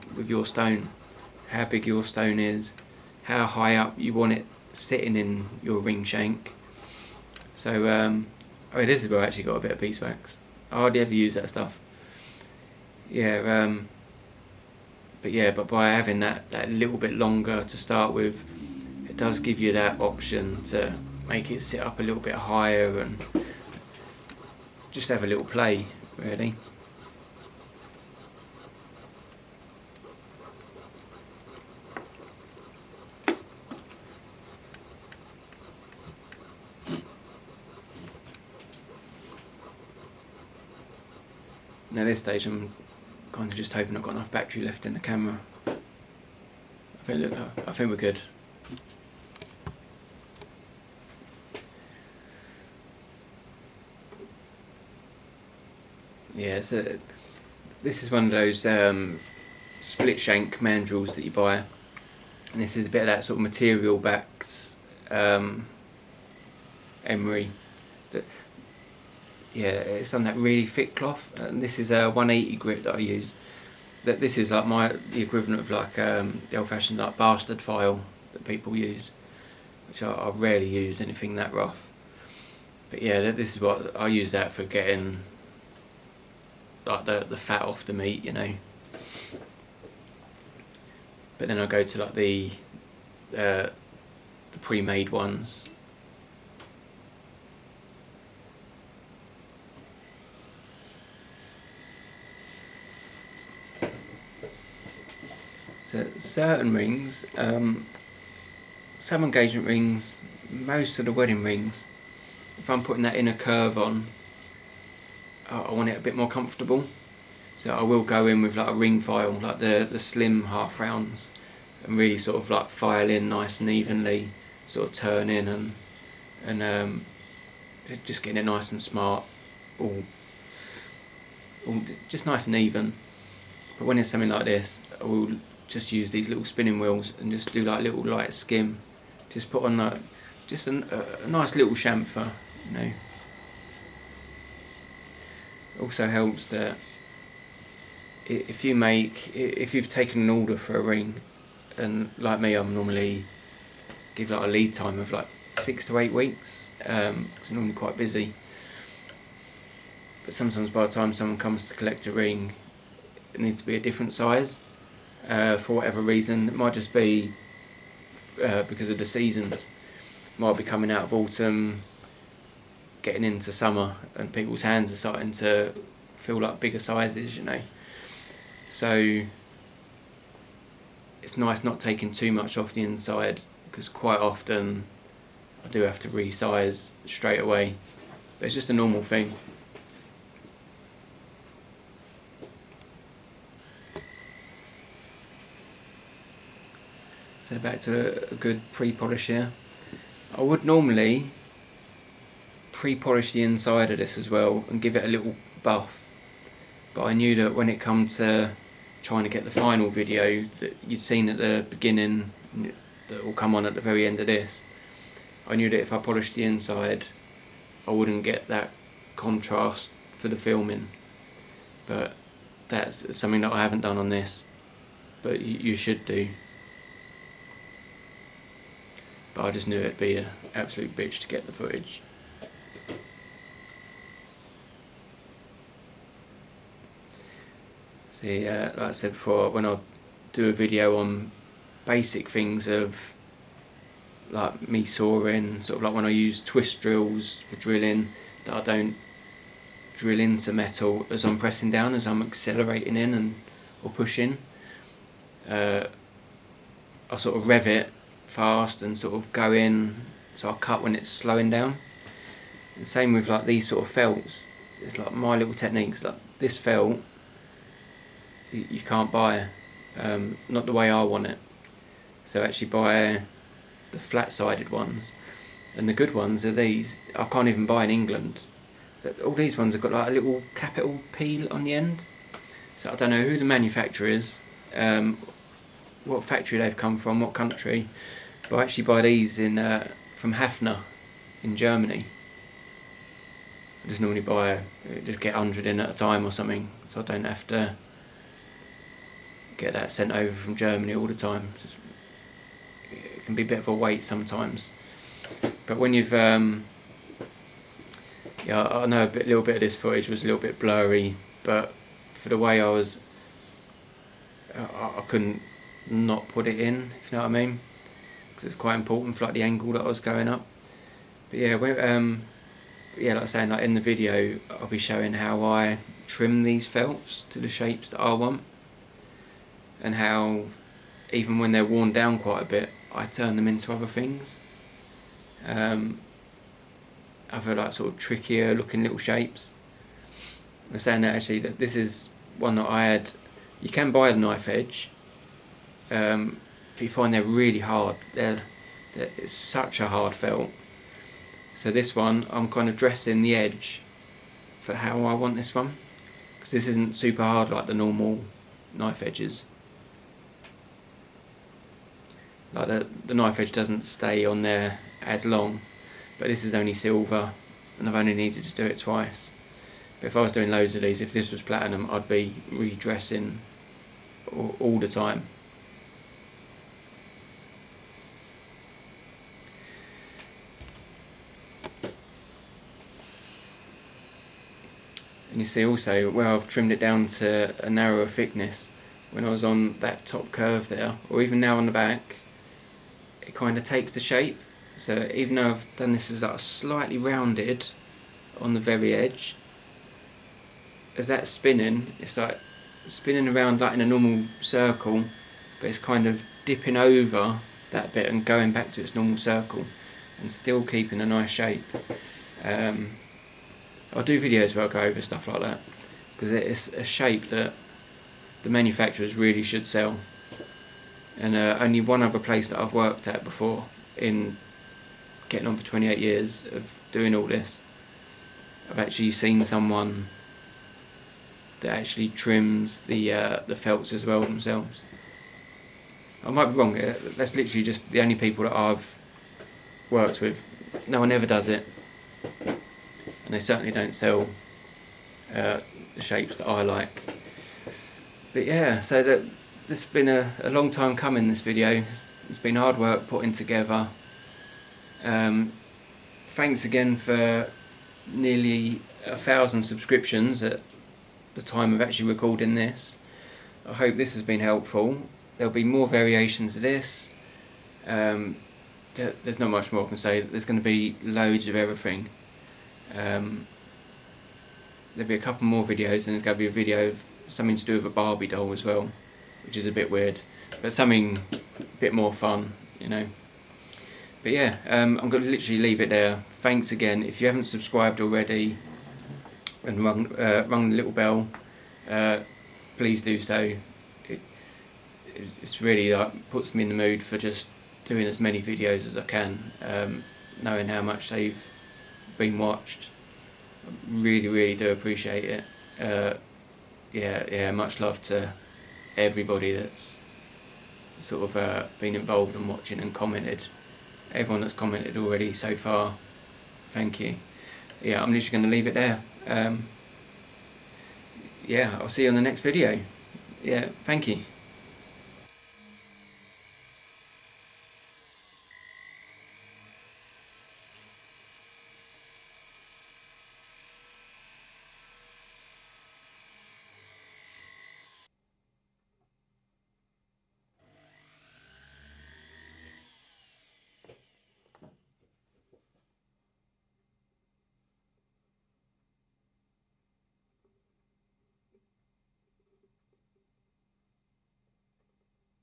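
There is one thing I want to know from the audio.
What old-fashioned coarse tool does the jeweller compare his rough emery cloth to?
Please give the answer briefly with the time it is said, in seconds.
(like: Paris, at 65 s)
Bastard file, at 77 s.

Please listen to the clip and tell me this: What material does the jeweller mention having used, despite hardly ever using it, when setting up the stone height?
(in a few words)
Beeswax.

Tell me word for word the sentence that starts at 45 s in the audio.
I think, look, I think we're good.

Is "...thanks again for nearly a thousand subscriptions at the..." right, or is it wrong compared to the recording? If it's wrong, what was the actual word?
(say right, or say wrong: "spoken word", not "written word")
right.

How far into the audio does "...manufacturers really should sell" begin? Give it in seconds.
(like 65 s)
418 s.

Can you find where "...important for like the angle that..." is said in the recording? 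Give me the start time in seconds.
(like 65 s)
318 s.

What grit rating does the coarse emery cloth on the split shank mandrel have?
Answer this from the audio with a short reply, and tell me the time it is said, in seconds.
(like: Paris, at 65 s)
180, at 72 s.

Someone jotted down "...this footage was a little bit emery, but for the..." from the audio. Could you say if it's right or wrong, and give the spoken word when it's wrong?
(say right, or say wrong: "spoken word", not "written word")
wrong: "blurry", not "emery".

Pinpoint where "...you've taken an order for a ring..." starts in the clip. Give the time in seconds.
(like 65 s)
149 s.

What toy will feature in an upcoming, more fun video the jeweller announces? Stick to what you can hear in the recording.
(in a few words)
Barbie doll.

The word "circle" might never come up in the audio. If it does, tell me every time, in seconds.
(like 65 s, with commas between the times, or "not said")
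404 s, 409 s.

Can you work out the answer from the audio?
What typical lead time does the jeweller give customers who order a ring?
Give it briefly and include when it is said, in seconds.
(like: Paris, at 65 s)
6 to 8 weeks, at 155 s.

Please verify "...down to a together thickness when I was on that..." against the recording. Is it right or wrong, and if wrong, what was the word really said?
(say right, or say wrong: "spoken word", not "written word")
wrong: "narrower", not "together".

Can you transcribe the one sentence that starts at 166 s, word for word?
It might just be uh, because of the seasons.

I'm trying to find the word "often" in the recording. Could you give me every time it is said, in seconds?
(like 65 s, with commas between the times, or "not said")
184 s.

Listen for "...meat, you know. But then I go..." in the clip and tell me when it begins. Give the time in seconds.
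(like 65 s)
87 s.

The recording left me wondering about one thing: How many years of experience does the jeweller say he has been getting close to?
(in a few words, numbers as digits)
28.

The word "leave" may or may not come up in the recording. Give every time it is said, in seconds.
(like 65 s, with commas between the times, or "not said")
485 s, 518 s.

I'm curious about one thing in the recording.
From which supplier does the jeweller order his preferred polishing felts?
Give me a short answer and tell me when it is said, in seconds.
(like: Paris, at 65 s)
Hafner, at 290 s.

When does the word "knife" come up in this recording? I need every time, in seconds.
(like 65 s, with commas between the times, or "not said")
344 s, 358 s, 363 s.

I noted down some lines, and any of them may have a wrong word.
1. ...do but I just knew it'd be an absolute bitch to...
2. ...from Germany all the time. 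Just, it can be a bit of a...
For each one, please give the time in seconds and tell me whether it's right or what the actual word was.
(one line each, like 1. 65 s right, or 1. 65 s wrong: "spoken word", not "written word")
1. 226 s right
2. 300 s right.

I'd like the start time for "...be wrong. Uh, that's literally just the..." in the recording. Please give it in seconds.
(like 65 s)
436 s.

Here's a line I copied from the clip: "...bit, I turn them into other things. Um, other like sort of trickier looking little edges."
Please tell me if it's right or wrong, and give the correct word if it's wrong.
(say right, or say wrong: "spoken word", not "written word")
wrong: "shapes", not "edges".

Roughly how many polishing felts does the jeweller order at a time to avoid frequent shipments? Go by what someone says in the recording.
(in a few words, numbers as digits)
100.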